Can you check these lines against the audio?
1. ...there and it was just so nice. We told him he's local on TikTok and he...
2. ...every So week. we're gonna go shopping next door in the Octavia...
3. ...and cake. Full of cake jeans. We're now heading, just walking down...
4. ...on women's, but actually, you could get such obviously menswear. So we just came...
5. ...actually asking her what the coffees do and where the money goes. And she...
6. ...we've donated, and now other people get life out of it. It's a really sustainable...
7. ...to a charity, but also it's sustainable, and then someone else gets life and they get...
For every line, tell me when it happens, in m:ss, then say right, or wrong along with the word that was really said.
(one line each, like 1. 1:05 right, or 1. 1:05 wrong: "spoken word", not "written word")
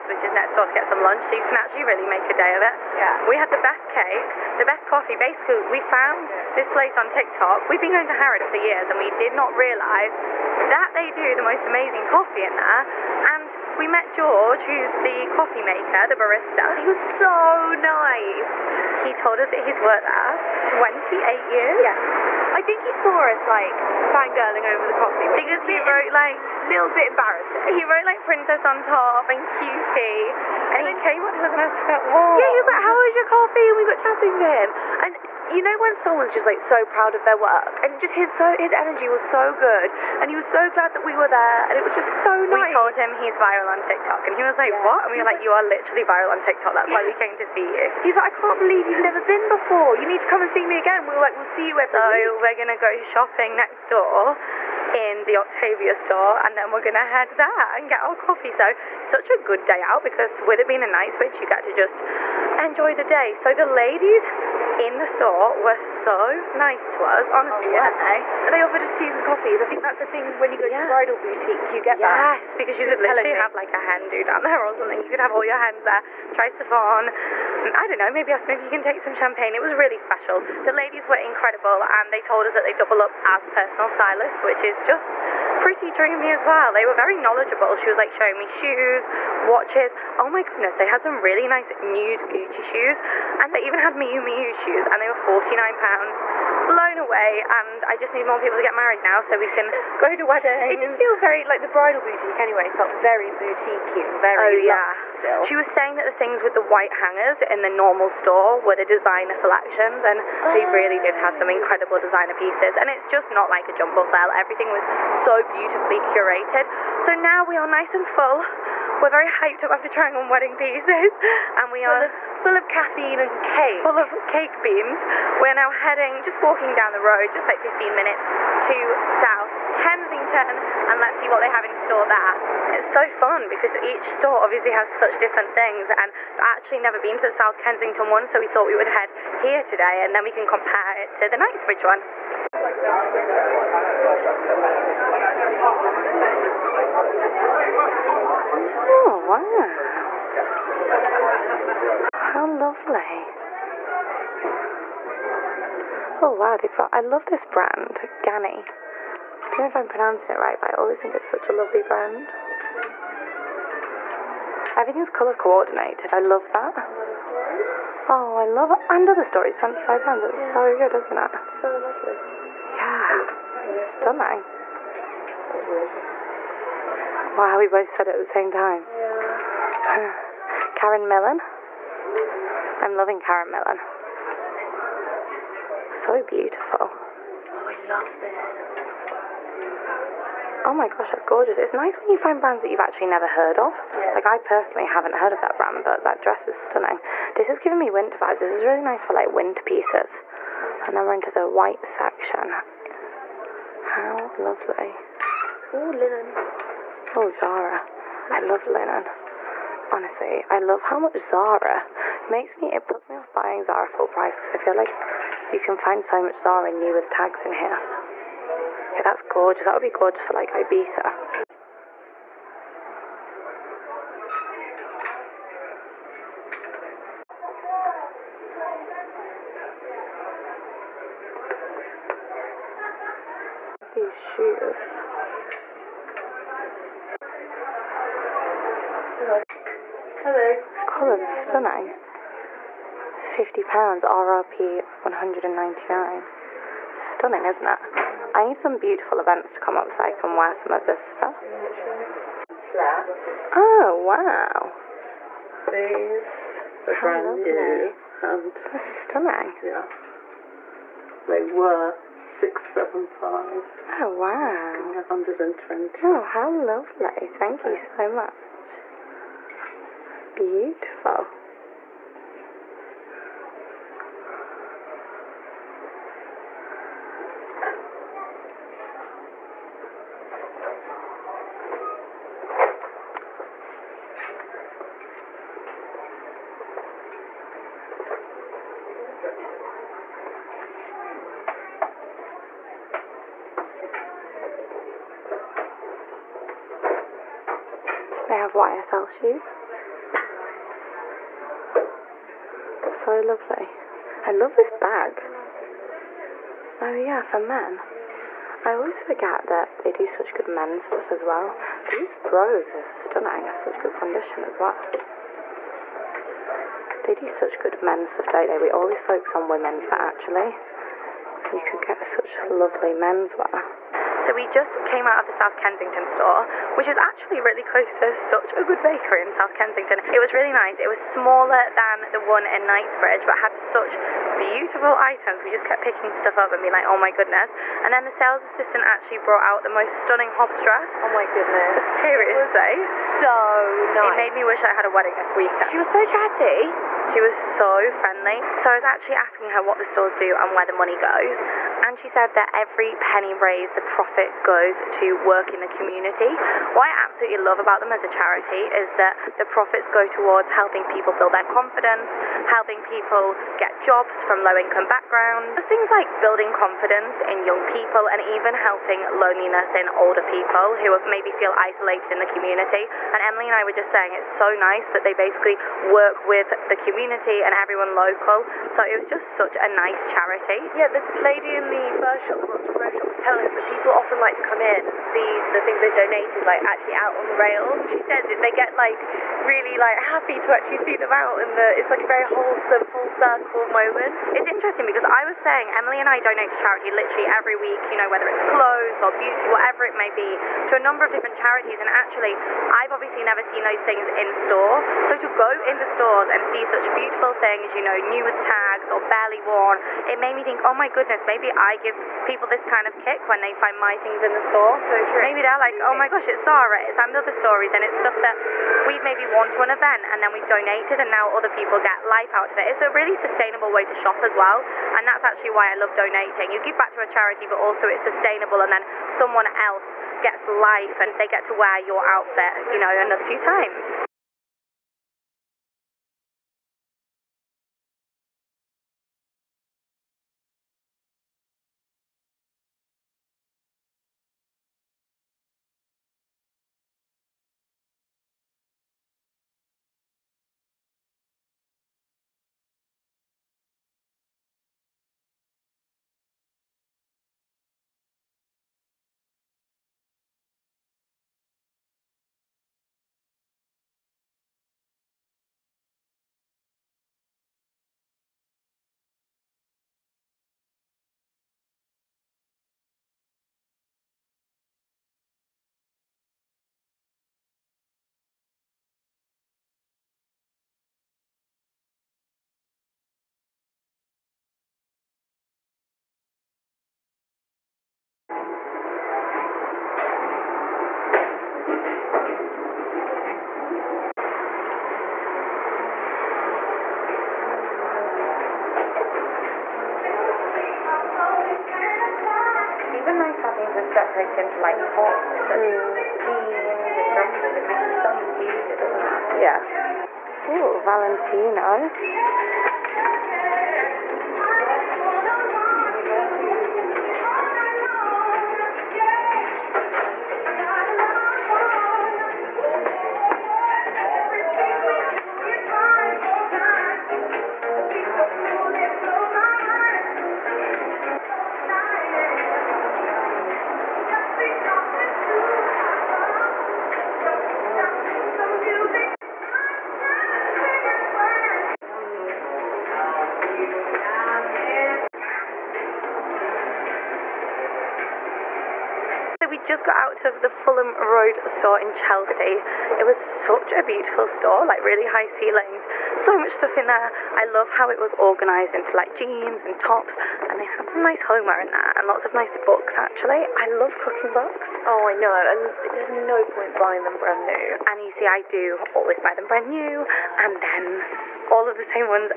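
1. 0:41 wrong: "viral", not "local"
2. 0:51 right
3. 2:03 wrong: "beans", not "jeans"
4. 5:19 wrong: "lovely", not "obviously"
5. 5:48 wrong: "stores", not "coffees"
6. 7:00 right
7. 7:06 right.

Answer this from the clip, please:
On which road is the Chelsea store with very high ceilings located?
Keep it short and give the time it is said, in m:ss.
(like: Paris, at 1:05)
Fulham Road, at 9:10.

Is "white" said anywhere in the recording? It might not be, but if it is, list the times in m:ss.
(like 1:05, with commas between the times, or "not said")
1:46, 3:21.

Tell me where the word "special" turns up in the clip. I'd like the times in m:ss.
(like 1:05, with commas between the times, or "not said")
1:19.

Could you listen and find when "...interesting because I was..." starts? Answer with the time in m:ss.
6:34.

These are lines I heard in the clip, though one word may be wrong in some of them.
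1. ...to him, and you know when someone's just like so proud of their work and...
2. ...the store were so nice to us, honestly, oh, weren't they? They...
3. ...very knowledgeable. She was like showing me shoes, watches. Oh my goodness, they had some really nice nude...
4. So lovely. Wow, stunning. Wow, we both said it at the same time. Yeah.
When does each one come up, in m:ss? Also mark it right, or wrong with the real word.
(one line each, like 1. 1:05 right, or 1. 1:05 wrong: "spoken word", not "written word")
1. 0:34 right
2. 1:04 right
3. 1:26 right
4. 2:51 right.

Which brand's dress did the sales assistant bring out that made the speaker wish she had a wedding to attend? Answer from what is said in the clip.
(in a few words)
Hobbs.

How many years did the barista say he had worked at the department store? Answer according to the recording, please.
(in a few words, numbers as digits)
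28.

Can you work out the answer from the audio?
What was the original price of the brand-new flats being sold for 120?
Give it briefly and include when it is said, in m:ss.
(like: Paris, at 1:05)
675, at 4:22.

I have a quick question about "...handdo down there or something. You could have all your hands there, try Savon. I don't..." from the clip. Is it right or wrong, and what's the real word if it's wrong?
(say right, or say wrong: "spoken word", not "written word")
right.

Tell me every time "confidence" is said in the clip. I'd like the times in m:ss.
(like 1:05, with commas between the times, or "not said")
6:01, 6:06.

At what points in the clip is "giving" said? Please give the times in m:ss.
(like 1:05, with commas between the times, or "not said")
3:17.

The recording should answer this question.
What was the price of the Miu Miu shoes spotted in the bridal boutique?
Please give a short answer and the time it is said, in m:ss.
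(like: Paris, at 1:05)
£49, at 1:35.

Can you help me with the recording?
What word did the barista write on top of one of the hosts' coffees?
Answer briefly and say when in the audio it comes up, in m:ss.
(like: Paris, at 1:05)
princess, at 0:28.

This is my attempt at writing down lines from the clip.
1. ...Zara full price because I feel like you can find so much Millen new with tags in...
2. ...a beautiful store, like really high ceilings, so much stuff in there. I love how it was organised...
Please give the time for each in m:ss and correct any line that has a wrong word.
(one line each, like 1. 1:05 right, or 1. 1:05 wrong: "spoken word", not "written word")
1. 3:33 wrong: "Zara", not "Millen"
2. 9:13 right.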